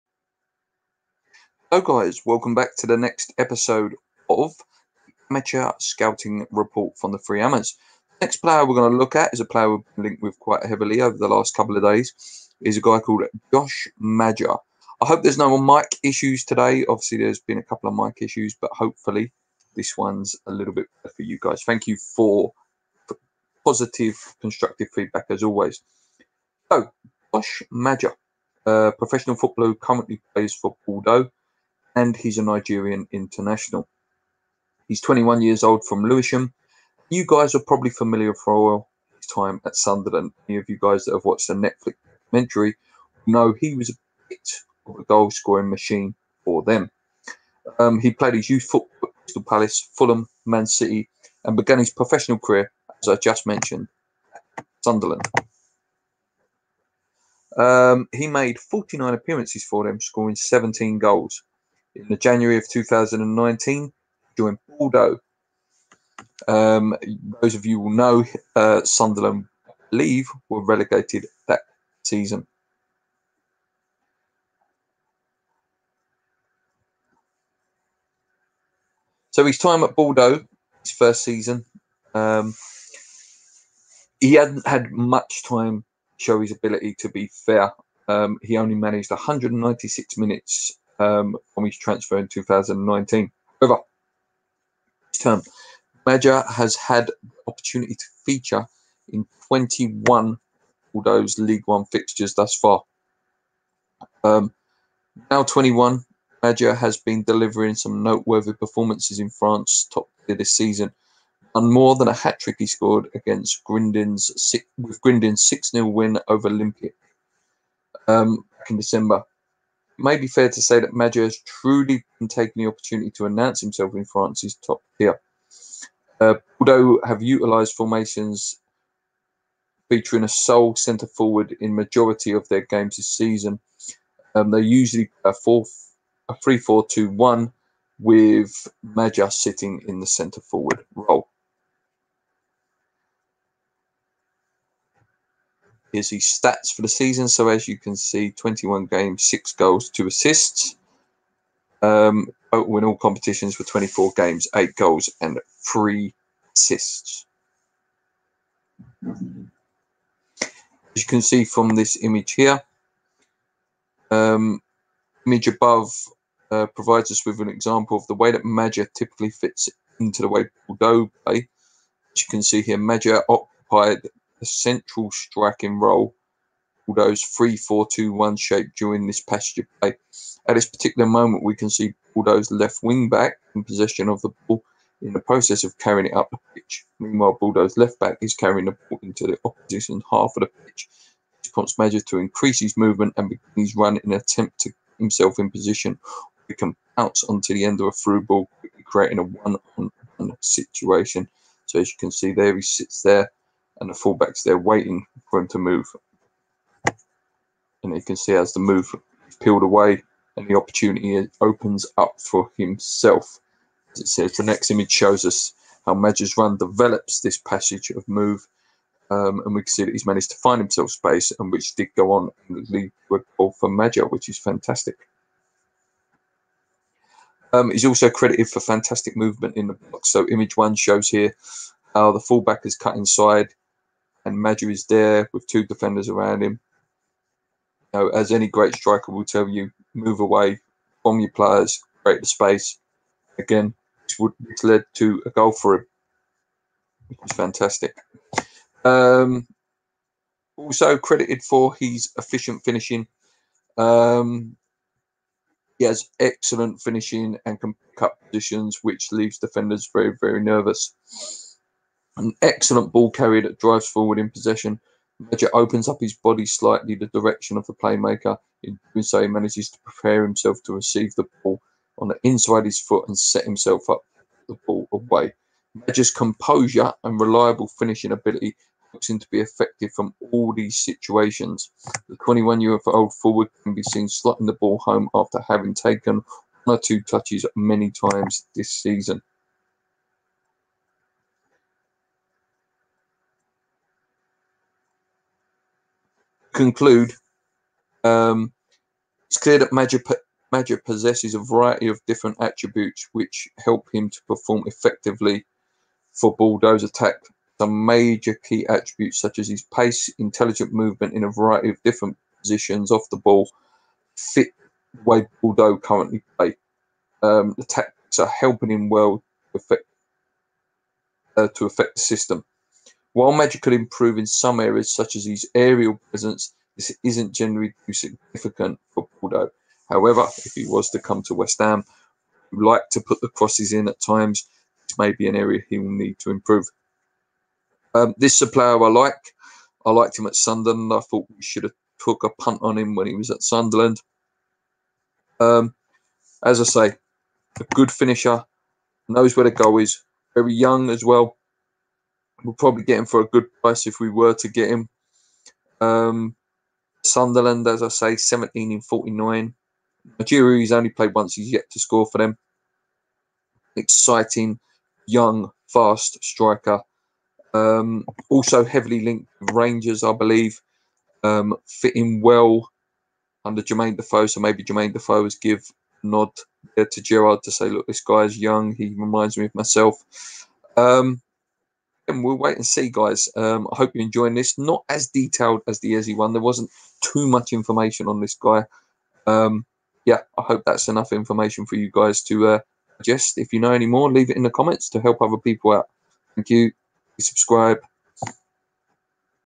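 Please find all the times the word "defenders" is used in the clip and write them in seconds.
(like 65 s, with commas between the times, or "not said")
235 s, 259 s.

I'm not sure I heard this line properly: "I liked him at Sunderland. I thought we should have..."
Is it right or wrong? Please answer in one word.
right.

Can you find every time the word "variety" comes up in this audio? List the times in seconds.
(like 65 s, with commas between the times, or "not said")
301 s, 311 s.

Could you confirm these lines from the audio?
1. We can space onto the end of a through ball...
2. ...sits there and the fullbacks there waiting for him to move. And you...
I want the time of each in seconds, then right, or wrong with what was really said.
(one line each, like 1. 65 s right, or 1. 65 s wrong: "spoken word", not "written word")
1. 196 s wrong: "bounce", not "space"
2. 202 s right.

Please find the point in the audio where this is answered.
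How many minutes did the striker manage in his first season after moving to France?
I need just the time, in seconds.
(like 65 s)
89 s.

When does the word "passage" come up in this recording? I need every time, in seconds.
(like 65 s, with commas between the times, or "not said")
179 s, 217 s.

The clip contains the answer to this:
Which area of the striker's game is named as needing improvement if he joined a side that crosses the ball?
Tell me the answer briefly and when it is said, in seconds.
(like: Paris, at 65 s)
Aerial presence, at 325 s.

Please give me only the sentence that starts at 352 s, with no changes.
We'll probably get him for a good price if we were to get him.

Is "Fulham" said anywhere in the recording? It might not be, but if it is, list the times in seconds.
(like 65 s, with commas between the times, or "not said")
49 s.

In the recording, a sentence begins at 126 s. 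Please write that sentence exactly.
Uh, Bordeaux have utilised formations featuring a sole centre forward in majority of their games this season.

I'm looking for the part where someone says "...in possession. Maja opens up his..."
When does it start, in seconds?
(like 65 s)
264 s.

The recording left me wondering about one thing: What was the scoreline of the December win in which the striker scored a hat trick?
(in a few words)
6-0.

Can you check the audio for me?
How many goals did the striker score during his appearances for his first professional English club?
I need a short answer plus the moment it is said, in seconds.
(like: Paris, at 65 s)
17, at 60 s.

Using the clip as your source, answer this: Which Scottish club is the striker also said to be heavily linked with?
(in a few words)
Rangers.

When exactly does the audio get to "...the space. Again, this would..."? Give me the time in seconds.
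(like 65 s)
242 s.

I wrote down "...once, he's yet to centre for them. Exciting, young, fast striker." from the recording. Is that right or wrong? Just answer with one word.
wrong.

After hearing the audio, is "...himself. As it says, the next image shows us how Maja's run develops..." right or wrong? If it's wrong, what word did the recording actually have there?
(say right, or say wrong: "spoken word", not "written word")
right.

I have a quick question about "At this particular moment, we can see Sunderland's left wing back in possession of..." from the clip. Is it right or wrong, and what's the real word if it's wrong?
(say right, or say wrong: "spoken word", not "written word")
wrong: "Bordeaux", not "Sunderland".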